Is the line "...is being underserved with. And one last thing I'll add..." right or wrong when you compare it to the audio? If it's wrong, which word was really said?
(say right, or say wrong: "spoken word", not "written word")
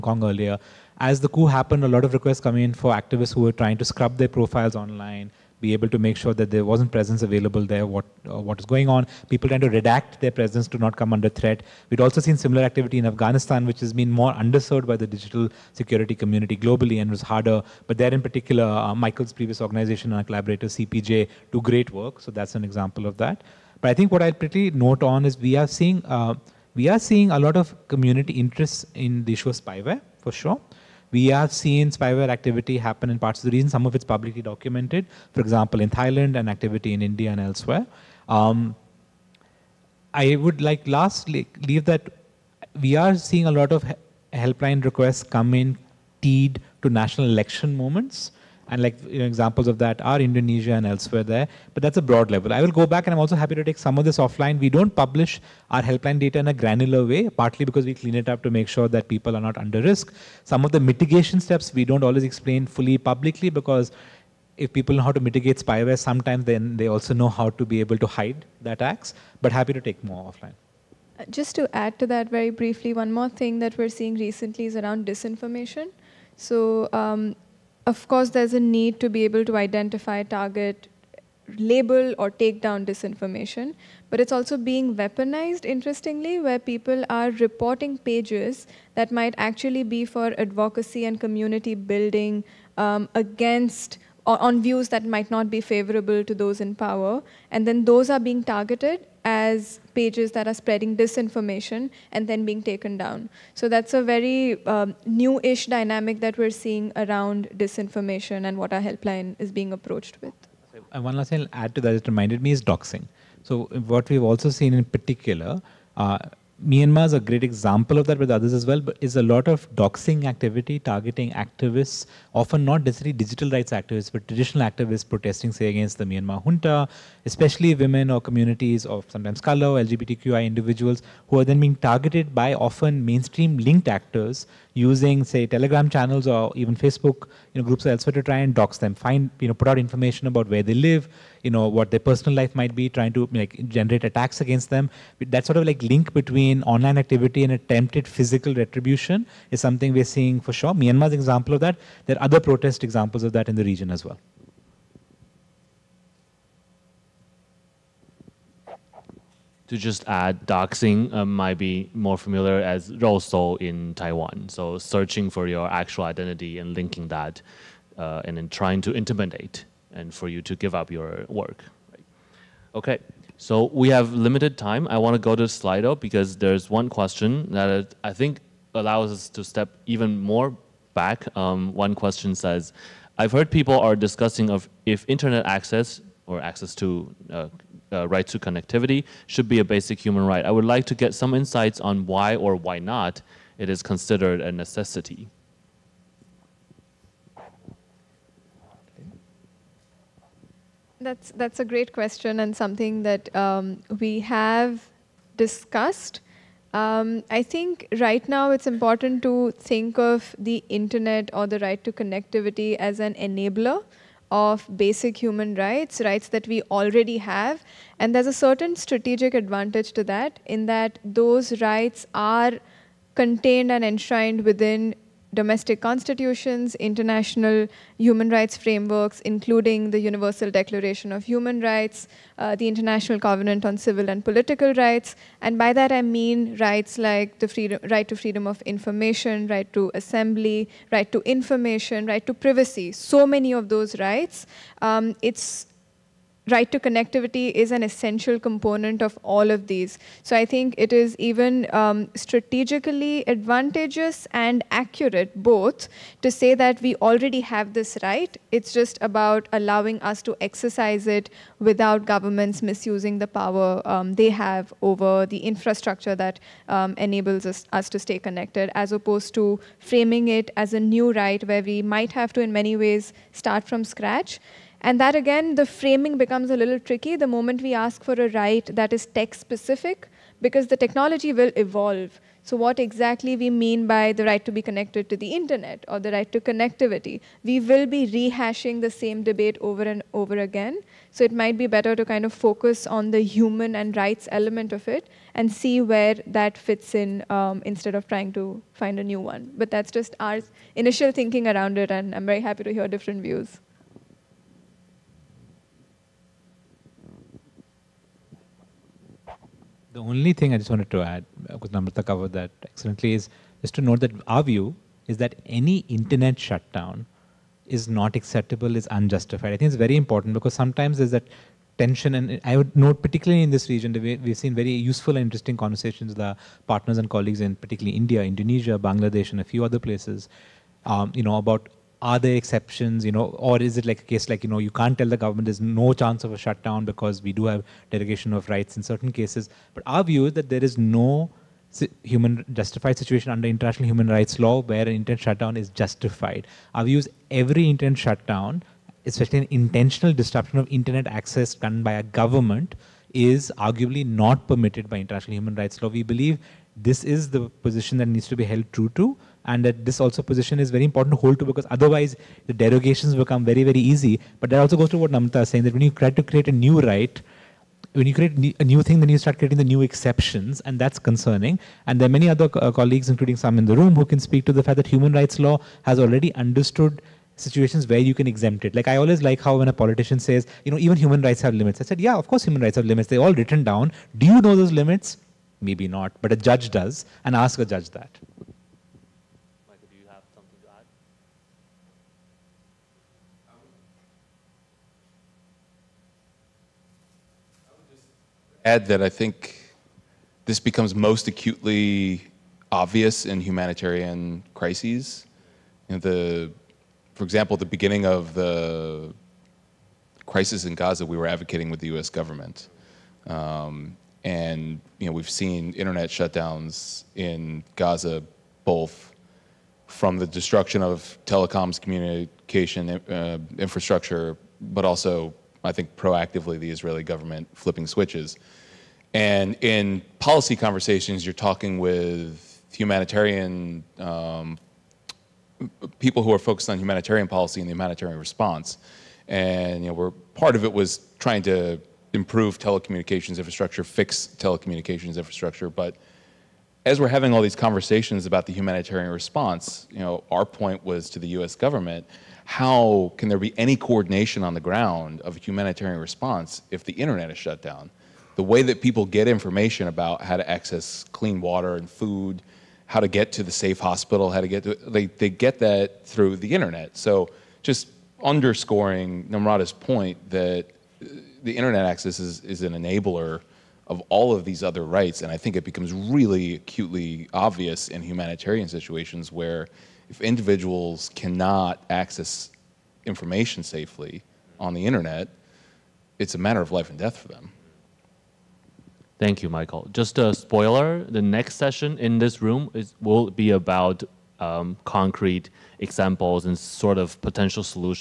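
wrong: "approached", not "underserved".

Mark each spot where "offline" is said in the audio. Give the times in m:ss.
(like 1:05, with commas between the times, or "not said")
0:54, 1:10.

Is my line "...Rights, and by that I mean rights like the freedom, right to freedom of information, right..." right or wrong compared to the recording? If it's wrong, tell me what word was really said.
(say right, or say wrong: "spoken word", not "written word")
right.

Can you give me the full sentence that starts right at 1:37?
And then those are being targeted as pages that are spreading disinformation and then being taken down.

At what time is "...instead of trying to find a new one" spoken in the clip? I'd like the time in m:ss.
4:57.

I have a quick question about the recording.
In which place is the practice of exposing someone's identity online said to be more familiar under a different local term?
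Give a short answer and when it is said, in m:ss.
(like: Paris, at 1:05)
Taiwan, at 2:43.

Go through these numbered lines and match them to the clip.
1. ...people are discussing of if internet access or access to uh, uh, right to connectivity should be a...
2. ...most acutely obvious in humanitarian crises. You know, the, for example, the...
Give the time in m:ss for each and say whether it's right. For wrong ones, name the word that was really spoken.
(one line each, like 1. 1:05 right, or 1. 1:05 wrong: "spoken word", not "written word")
1. 3:03 right
2. 6:41 right.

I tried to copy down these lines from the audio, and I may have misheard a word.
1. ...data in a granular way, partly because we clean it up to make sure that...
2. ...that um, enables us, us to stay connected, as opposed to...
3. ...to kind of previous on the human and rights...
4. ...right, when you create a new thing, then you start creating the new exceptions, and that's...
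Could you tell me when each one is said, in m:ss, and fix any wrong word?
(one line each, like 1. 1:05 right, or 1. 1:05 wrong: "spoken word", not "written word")
1. 0:56 right
2. 4:26 right
3. 4:51 wrong: "focus", not "previous"
4. 6:06 right.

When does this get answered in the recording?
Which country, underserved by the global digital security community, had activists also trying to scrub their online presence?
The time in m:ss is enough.
0:13.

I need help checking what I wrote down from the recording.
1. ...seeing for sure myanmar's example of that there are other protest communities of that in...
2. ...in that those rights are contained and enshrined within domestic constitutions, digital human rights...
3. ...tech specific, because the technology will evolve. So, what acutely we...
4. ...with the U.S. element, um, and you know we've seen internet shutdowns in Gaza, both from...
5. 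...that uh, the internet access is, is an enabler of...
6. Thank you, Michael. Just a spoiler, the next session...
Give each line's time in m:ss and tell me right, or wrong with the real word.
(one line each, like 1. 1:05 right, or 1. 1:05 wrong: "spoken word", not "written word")
1. 2:30 wrong: "examples", not "communities"
2. 3:40 wrong: "international", not "digital"
3. 4:39 wrong: "exactly", not "acutely"
4. 6:51 wrong: "government", not "element"
5. 7:50 right
6. 8:09 right.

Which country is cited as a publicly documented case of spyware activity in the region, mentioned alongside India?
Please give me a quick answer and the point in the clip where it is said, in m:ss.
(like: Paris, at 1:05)
Thailand, at 0:35.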